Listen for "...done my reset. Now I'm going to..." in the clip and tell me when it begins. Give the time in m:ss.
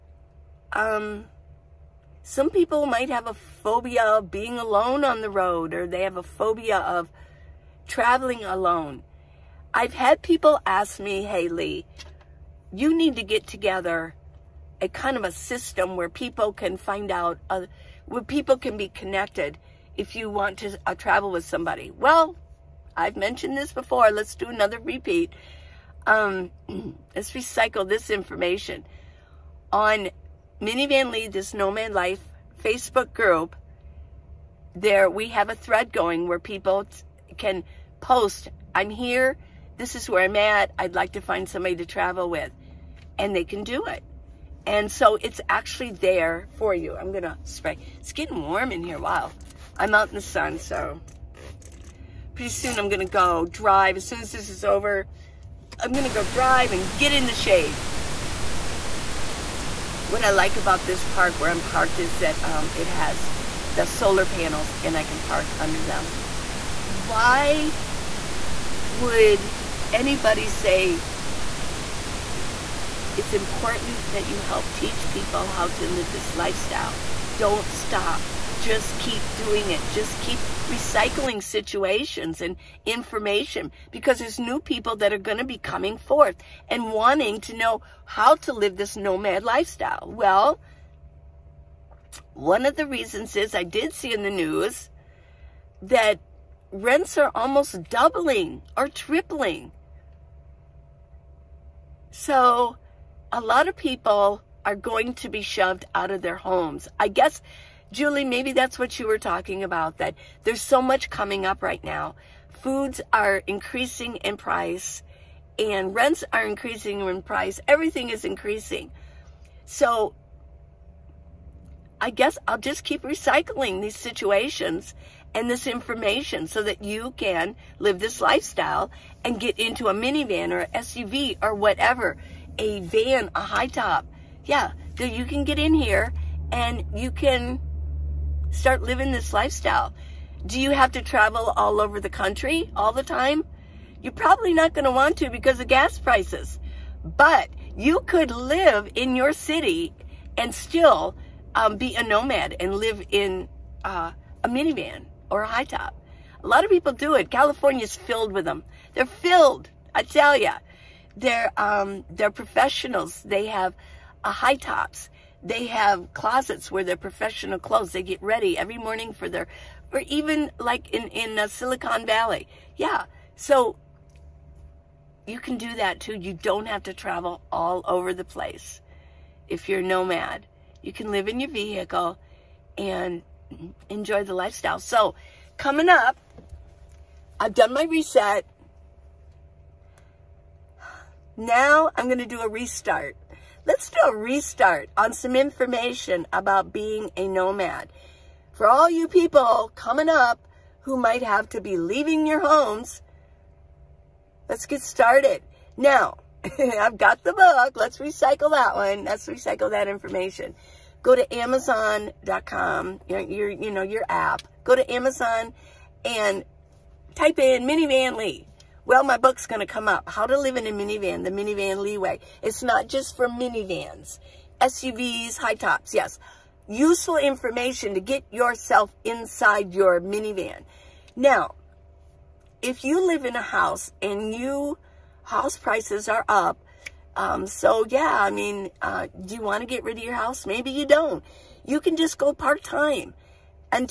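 3:07.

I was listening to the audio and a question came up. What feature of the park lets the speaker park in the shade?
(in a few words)
Solar panels.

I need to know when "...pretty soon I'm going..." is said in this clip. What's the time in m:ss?
0:52.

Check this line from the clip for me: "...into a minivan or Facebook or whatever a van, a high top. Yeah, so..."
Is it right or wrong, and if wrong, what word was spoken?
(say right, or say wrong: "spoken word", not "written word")
wrong: "SUV", not "Facebook".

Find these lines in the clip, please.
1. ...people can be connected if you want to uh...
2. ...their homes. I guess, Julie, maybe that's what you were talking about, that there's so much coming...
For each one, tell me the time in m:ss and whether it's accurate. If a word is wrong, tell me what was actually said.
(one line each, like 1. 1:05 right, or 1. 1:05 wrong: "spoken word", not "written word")
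1. 0:18 right
2. 1:46 right.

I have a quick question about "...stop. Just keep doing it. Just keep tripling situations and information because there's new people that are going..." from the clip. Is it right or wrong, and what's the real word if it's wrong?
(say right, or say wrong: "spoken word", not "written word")
wrong: "recycling", not "tripling".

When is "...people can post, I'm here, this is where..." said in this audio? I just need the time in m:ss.
0:36.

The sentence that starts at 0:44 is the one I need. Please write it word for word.
And so it's actually there for you.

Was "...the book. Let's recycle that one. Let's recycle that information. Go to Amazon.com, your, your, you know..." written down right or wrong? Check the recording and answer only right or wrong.
right.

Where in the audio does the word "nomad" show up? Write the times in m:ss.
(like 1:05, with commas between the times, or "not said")
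0:31, 1:28, 2:32, 2:59, 3:17.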